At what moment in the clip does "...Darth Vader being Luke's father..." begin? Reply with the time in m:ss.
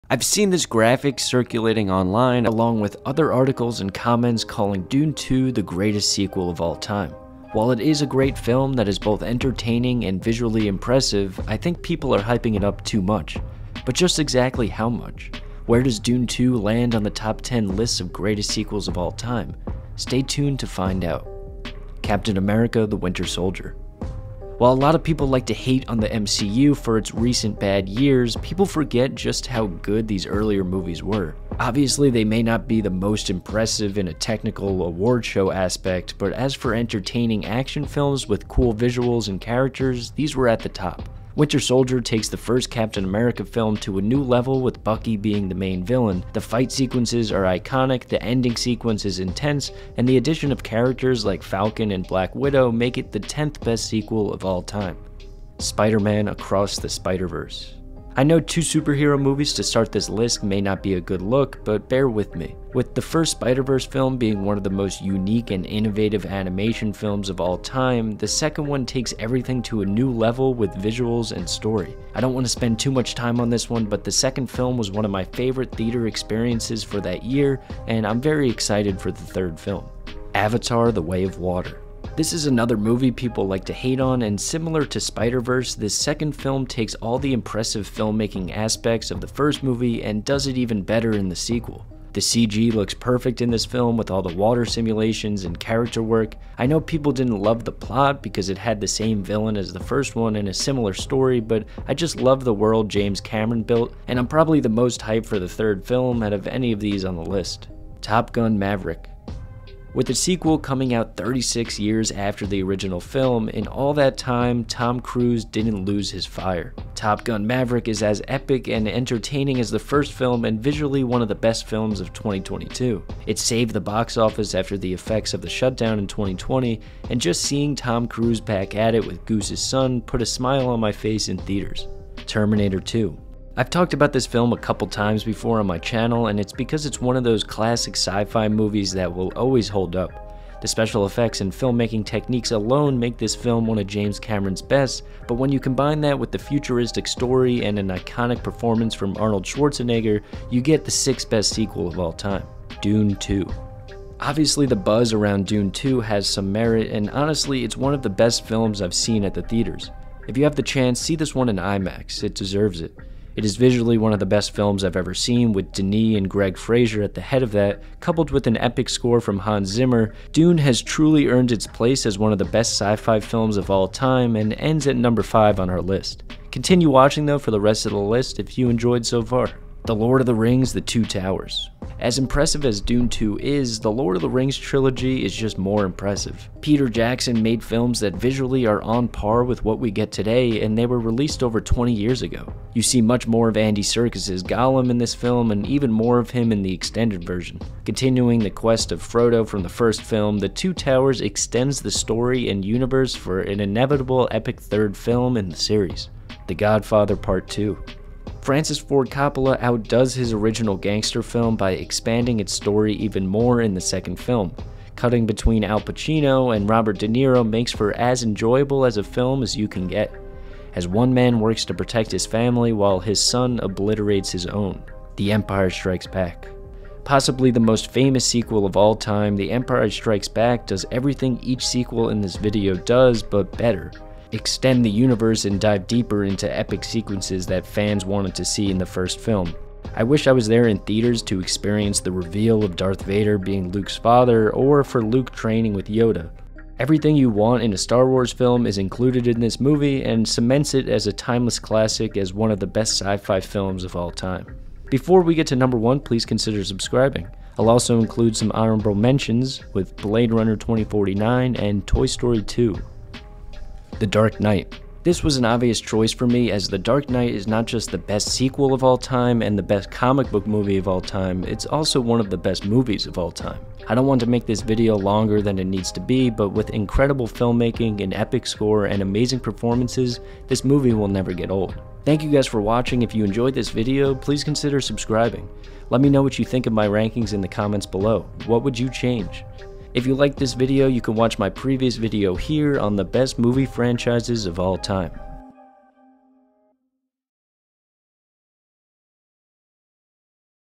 4:02.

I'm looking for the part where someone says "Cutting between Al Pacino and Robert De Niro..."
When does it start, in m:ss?
3:34.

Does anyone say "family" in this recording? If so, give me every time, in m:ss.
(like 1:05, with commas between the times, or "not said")
3:42.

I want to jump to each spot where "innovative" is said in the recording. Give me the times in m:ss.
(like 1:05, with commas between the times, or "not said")
1:05.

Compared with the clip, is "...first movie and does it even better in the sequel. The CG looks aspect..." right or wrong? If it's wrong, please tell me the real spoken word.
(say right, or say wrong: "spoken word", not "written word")
wrong: "perfect", not "aspect".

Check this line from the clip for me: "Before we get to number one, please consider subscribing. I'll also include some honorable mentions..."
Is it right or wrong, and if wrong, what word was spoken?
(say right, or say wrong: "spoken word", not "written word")
right.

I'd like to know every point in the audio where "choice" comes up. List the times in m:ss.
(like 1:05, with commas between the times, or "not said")
4:25.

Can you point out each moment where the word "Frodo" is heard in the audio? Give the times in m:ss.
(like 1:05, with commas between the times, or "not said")
3:19.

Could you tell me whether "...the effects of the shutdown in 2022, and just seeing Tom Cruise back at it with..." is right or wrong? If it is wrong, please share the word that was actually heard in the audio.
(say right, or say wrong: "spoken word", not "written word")
wrong: "2020", not "2022".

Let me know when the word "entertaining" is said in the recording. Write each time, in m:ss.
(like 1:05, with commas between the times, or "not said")
0:09, 0:36, 1:58.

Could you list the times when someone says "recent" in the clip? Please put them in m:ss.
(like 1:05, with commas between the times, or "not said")
0:27.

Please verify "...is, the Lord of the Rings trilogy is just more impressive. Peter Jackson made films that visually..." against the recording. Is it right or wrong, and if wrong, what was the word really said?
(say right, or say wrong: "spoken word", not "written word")
right.